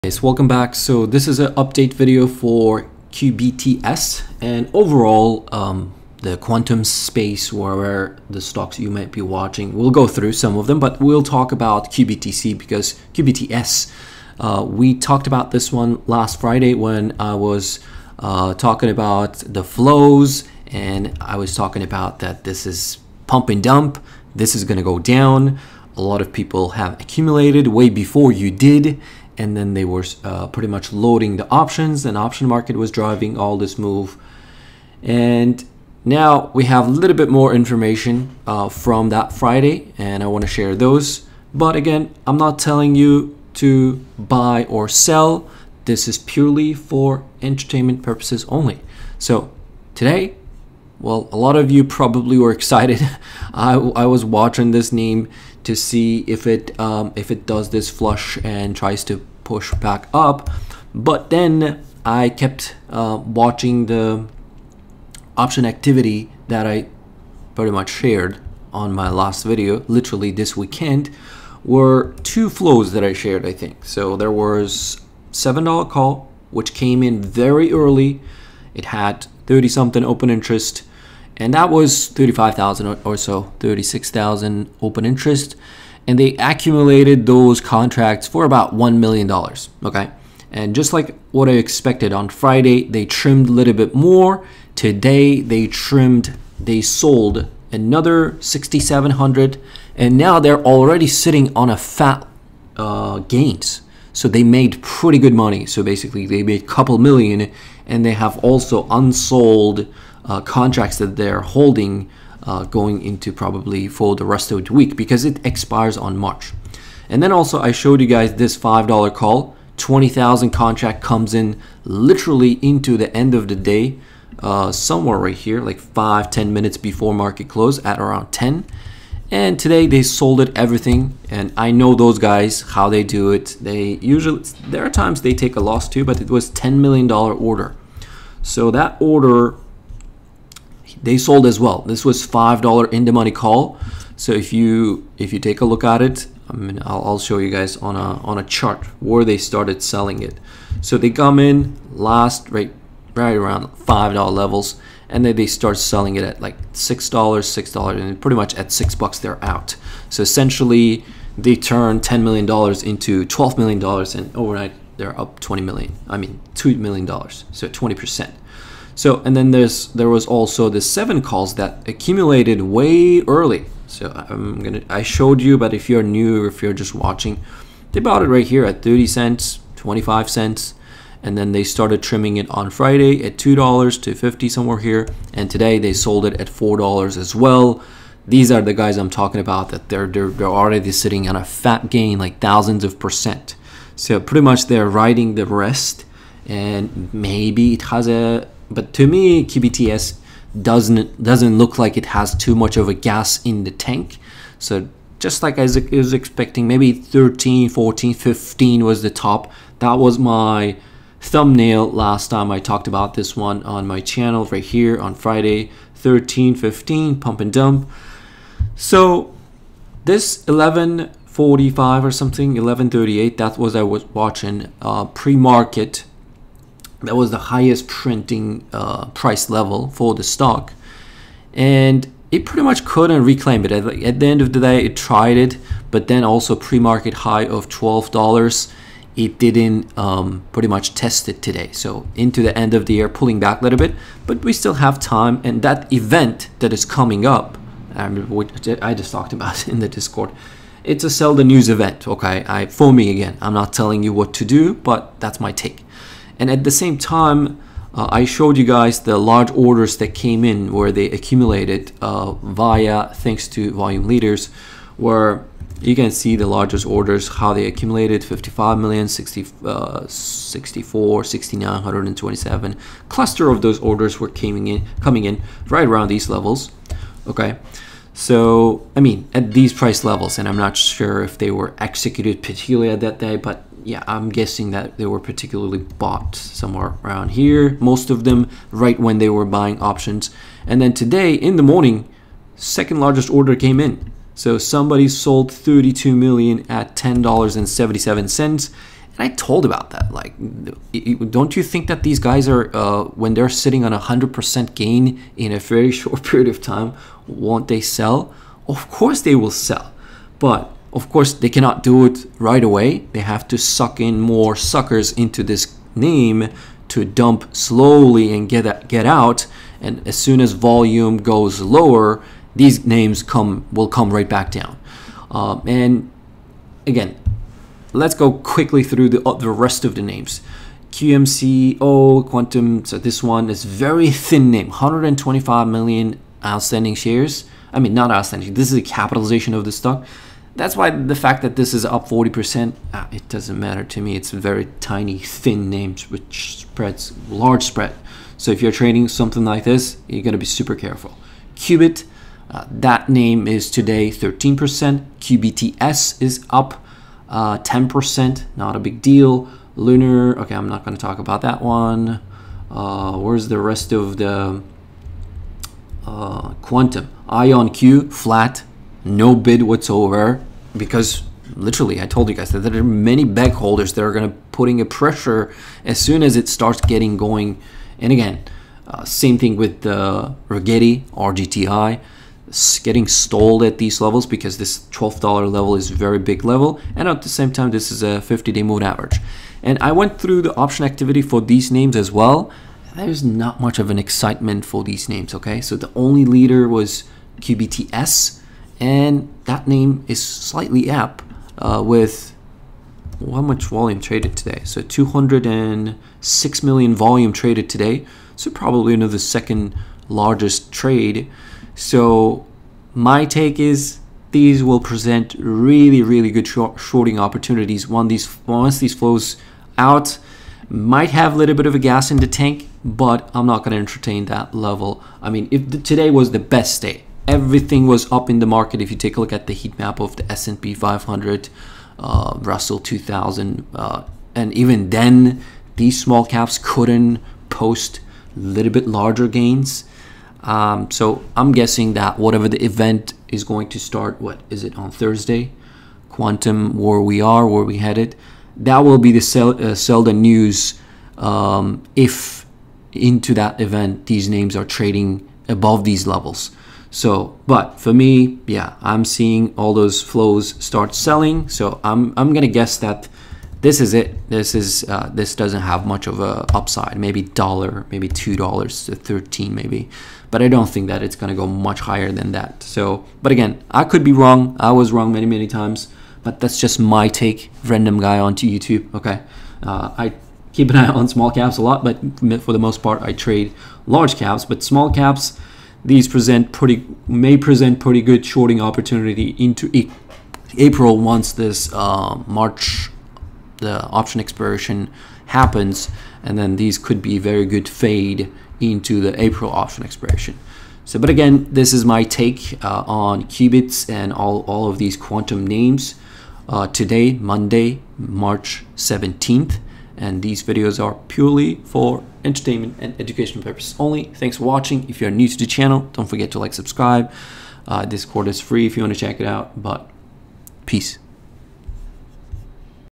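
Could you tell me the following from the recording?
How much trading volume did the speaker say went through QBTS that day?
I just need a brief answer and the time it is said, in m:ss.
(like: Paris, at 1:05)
206 million, at 6:44.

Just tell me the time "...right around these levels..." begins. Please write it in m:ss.
4:35.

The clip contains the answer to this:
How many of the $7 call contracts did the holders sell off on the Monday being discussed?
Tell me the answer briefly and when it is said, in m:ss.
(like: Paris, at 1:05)
6,700, at 1:38.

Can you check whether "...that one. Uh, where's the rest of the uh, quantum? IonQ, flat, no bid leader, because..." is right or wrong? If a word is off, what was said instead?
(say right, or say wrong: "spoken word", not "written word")
wrong: "whatsoever", not "leader".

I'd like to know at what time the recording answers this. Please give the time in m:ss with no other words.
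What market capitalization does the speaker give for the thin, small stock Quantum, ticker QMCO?
5:34.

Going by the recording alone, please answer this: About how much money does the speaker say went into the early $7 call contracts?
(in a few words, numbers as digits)
$1 million.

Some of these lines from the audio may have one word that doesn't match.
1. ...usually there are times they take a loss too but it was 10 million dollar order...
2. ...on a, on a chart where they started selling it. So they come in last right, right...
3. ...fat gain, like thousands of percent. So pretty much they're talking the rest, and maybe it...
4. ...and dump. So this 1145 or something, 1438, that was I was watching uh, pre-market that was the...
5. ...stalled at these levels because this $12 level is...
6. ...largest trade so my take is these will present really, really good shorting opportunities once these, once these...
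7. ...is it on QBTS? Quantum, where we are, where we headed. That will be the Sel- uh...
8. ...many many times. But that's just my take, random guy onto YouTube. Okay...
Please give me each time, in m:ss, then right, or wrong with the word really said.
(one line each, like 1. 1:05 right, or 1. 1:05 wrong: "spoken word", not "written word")
1. 2:14 right
2. 2:27 right
3. 3:11 wrong: "riding", not "talking"
4. 3:37 wrong: "1138", not "1438"
5. 6:23 right
6. 6:50 right
7. 7:24 wrong: "Thursday", not "QBTS"
8. 7:55 right.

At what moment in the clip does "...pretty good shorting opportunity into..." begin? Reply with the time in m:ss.
8:07.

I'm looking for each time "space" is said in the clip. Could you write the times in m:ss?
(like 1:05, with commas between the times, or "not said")
0:06.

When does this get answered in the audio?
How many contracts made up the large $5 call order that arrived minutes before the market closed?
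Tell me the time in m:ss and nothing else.
1:59.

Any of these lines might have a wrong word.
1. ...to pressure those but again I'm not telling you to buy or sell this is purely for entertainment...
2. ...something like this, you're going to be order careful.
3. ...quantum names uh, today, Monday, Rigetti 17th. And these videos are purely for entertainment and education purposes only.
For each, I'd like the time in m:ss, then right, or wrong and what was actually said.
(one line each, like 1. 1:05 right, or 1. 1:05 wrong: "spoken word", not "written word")
1. 0:40 wrong: "share", not "pressure"
2. 5:49 wrong: "super", not "order"
3. 8:24 wrong: "March", not "Rigetti".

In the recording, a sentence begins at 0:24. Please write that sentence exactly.
This is going to go down.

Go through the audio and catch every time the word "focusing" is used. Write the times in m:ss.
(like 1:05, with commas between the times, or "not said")
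not said.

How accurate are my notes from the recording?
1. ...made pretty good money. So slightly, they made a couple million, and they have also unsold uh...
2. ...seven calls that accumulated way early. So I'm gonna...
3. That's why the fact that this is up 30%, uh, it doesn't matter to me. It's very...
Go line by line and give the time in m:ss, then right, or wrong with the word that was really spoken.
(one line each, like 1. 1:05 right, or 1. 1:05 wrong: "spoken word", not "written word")
1. 1:44 wrong: "basically", not "slightly"
2. 2:50 right
3. 5:40 wrong: "40", not "30".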